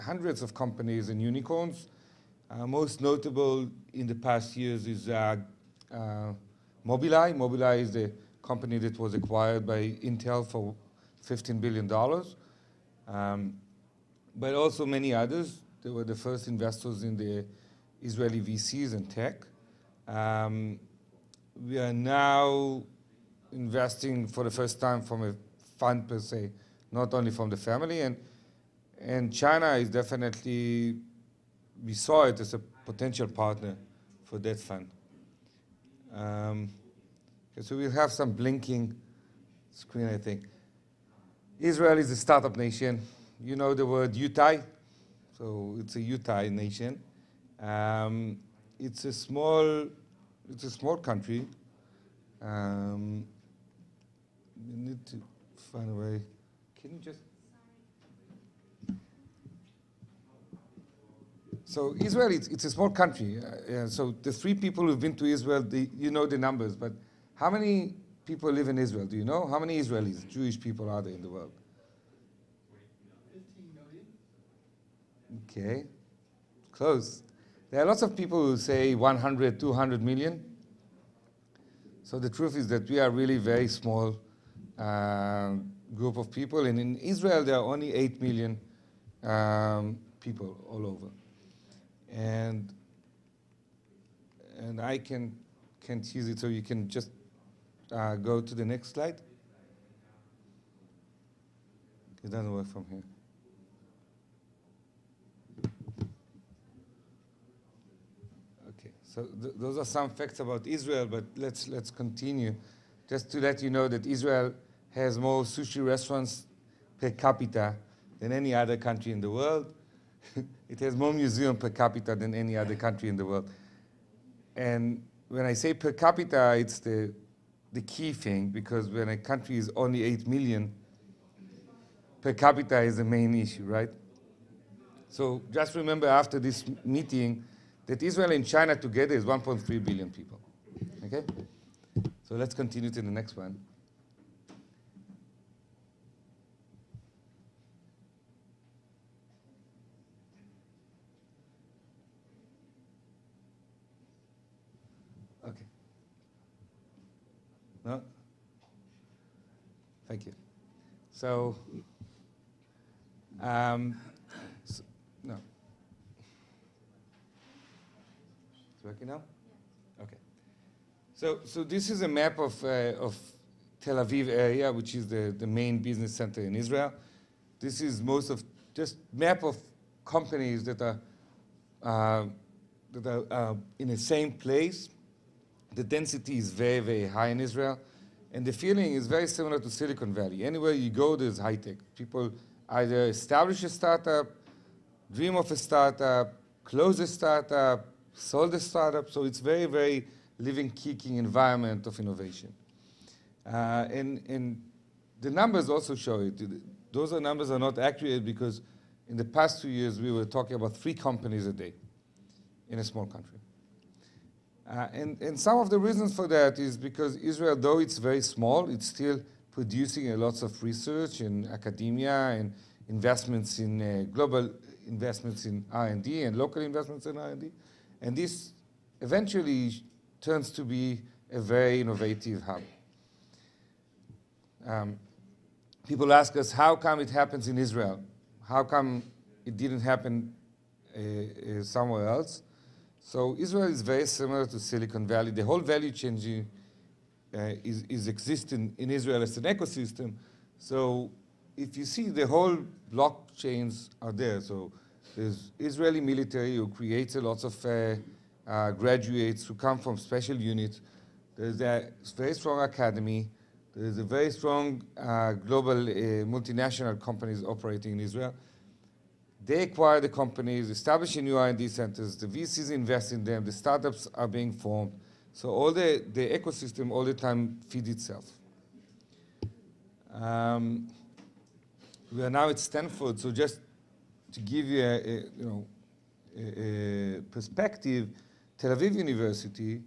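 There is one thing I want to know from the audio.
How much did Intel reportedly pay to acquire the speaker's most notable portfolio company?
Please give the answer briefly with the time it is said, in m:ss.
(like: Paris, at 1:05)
$15 billion, at 0:11.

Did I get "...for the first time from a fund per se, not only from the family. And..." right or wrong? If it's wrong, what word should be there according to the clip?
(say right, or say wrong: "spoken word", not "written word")
right.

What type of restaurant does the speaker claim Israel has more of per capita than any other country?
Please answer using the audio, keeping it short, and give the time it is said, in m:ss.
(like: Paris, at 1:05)
Sushi restaurants, at 1:55.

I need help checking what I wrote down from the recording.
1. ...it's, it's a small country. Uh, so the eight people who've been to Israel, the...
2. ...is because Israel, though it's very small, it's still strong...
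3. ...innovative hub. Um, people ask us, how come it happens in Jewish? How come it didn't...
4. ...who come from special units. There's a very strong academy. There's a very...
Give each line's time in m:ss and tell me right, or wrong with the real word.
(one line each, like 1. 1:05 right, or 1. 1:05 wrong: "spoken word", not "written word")
1. 1:02 wrong: "three", not "eight"
2. 3:36 wrong: "producing", not "strong"
3. 3:51 wrong: "Israel", not "Jewish"
4. 4:19 right.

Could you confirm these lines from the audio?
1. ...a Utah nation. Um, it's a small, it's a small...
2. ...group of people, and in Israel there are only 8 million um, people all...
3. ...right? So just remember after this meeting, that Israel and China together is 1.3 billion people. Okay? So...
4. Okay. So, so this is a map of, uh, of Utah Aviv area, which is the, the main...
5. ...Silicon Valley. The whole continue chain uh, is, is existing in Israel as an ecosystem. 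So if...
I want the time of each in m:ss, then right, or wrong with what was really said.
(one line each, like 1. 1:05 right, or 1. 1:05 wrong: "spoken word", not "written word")
1. 0:45 right
2. 1:25 right
3. 2:13 right
4. 2:50 wrong: "Tel", not "Utah"
5. 4:04 wrong: "value", not "continue".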